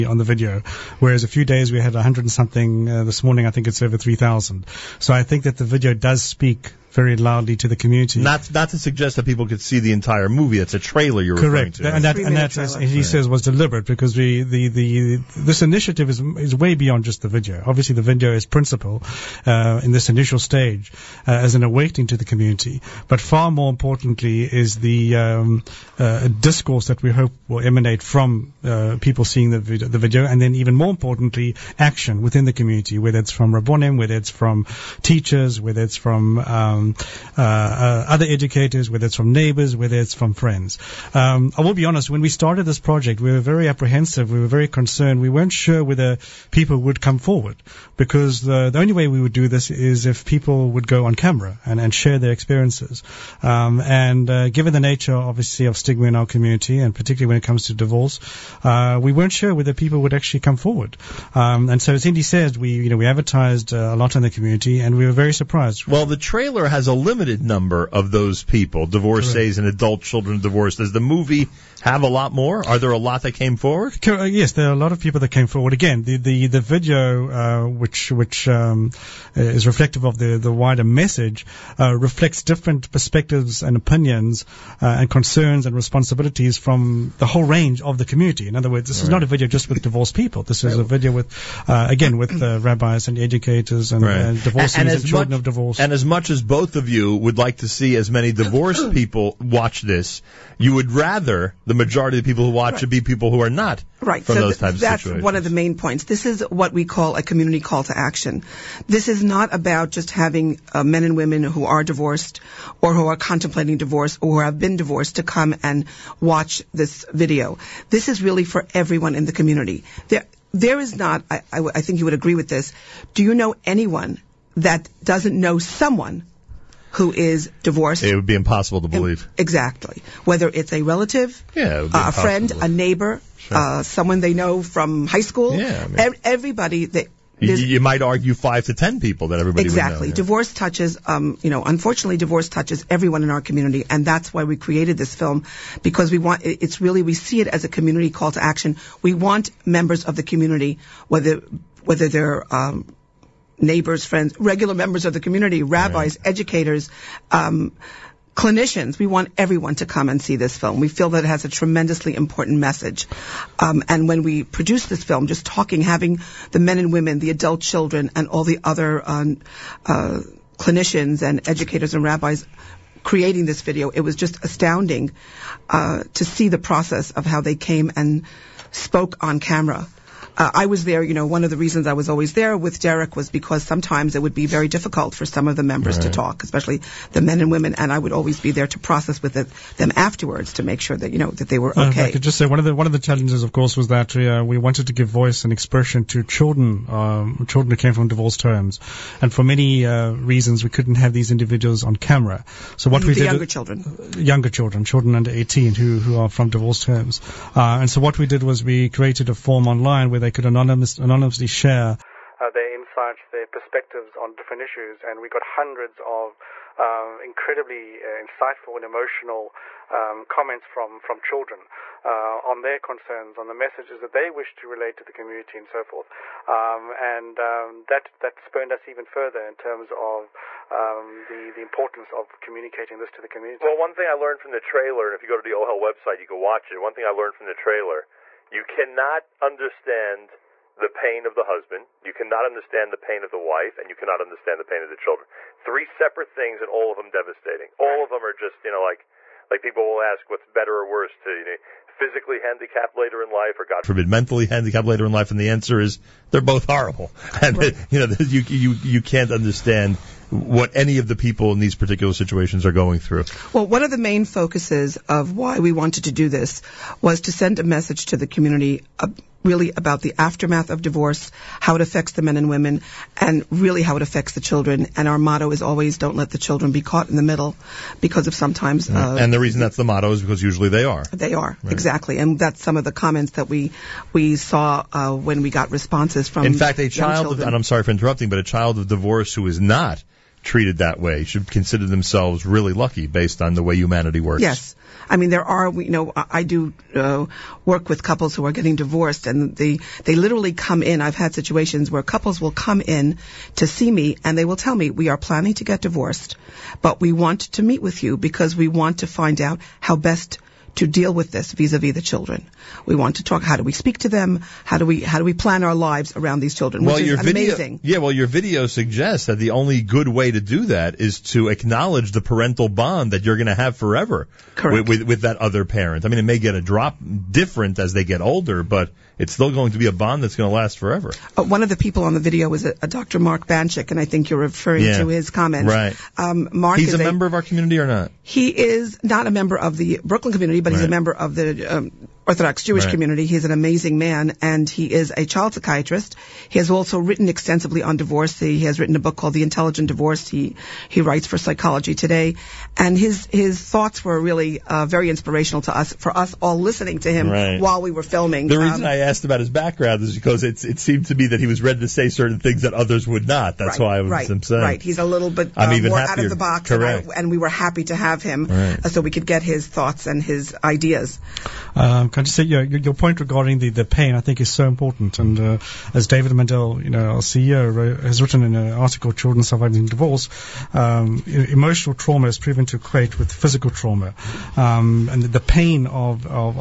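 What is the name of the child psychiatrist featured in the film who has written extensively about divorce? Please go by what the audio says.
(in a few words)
Mark Banschick.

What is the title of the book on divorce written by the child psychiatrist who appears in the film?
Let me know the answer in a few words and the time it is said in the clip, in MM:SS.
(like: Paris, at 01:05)
The Intelligent Divorce, at 05:49.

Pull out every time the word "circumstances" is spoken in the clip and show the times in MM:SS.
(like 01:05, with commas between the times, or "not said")
not said.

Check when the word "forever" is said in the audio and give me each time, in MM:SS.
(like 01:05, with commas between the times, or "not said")
05:23, 05:30.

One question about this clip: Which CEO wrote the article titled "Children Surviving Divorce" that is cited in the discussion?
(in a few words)
David Mandel.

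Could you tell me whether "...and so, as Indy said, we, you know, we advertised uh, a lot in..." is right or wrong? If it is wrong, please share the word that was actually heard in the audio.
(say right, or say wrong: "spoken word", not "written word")
right.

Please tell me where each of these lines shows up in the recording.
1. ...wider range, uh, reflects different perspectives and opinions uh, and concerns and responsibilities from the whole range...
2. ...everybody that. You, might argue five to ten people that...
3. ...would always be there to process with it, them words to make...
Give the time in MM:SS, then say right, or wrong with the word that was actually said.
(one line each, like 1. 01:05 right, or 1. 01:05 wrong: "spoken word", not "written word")
1. 01:20 wrong: "message", not "range"
2. 02:16 right
3. 03:07 wrong: "afterwards", not "words".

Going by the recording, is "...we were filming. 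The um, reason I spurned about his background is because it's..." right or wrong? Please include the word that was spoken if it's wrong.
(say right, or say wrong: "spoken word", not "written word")
wrong: "asked", not "spurned".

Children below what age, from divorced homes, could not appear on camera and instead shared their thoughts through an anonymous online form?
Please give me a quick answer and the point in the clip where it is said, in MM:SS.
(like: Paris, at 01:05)
18, at 03:25.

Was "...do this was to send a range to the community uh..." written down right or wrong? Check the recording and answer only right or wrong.
wrong.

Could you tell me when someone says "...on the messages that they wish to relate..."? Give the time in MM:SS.
03:43.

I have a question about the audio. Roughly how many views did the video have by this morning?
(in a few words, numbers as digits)
over 3,000.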